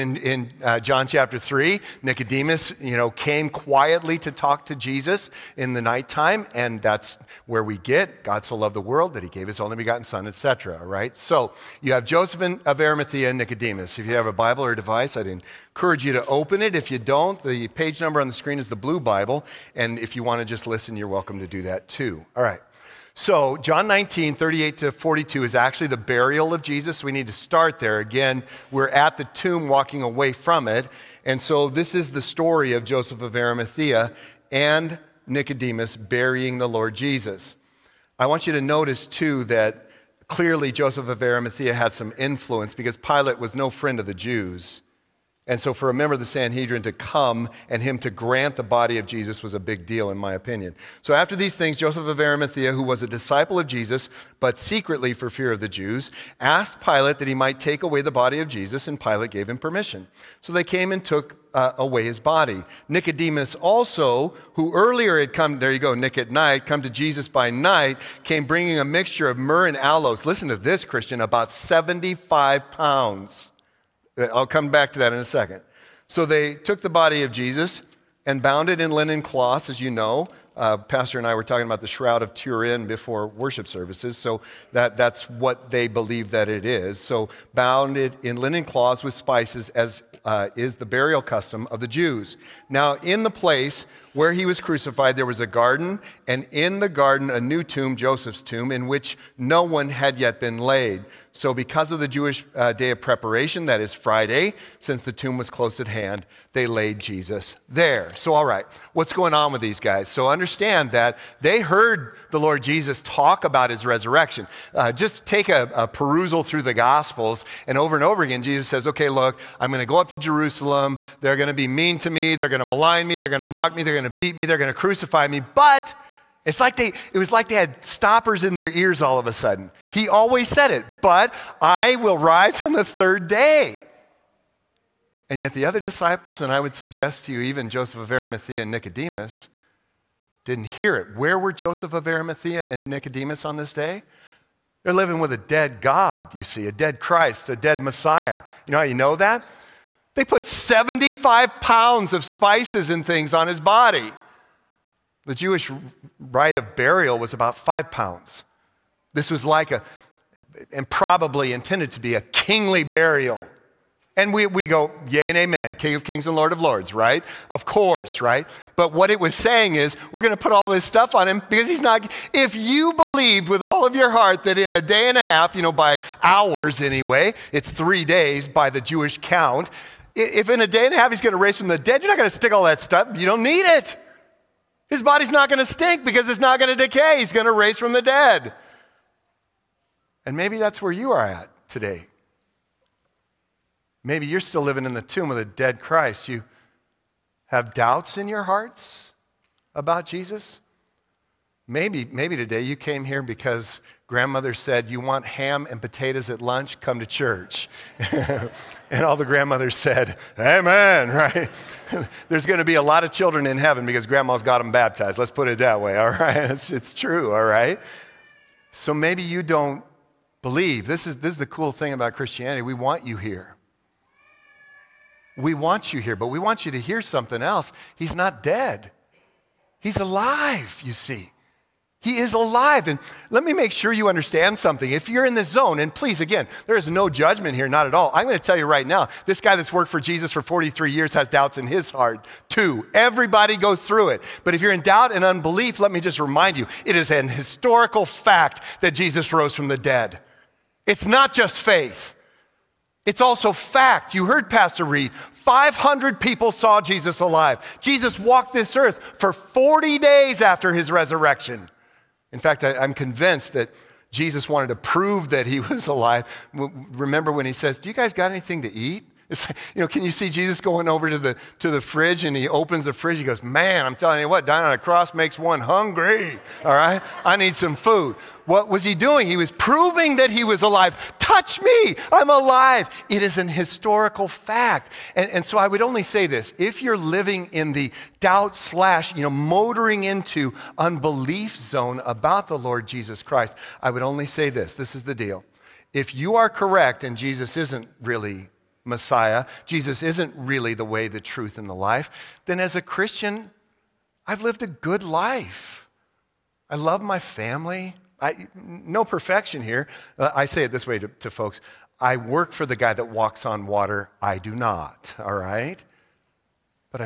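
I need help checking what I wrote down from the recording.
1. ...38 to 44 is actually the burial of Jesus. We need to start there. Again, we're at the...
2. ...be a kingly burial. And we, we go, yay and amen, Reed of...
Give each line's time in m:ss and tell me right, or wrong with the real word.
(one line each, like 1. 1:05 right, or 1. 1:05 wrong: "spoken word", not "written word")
1. 0:24 wrong: "42", not "44"
2. 2:41 wrong: "King", not "Reed".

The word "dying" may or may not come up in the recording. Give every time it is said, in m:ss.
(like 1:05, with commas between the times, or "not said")
4:34.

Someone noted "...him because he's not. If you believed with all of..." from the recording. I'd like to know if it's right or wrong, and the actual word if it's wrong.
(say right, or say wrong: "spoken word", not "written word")
right.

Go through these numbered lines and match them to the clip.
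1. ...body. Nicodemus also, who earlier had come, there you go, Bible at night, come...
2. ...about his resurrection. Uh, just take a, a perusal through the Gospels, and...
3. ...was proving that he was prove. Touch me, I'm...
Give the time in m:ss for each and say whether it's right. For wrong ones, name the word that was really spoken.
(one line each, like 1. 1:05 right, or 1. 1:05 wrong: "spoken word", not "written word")
1. 1:02 wrong: "Nick", not "Bible"
2. 1:53 right
3. 4:39 wrong: "alive", not "prove".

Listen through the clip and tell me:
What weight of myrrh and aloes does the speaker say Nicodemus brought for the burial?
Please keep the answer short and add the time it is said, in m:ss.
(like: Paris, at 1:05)
75 pounds, at 1:11.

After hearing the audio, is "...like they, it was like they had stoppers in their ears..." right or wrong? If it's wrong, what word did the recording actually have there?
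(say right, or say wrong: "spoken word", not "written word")
right.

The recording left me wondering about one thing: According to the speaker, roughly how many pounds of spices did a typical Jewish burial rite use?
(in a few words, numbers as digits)
5 pounds.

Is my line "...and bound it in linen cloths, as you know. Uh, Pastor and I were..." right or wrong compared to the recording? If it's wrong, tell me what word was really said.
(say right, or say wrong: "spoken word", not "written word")
right.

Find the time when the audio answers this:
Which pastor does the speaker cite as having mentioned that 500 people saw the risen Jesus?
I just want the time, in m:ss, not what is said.
4:14.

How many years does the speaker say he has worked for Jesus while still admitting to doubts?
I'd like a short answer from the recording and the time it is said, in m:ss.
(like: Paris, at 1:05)
43, at 4:00.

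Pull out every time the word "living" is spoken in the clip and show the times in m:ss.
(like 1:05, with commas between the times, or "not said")
2:24, 3:14, 4:46.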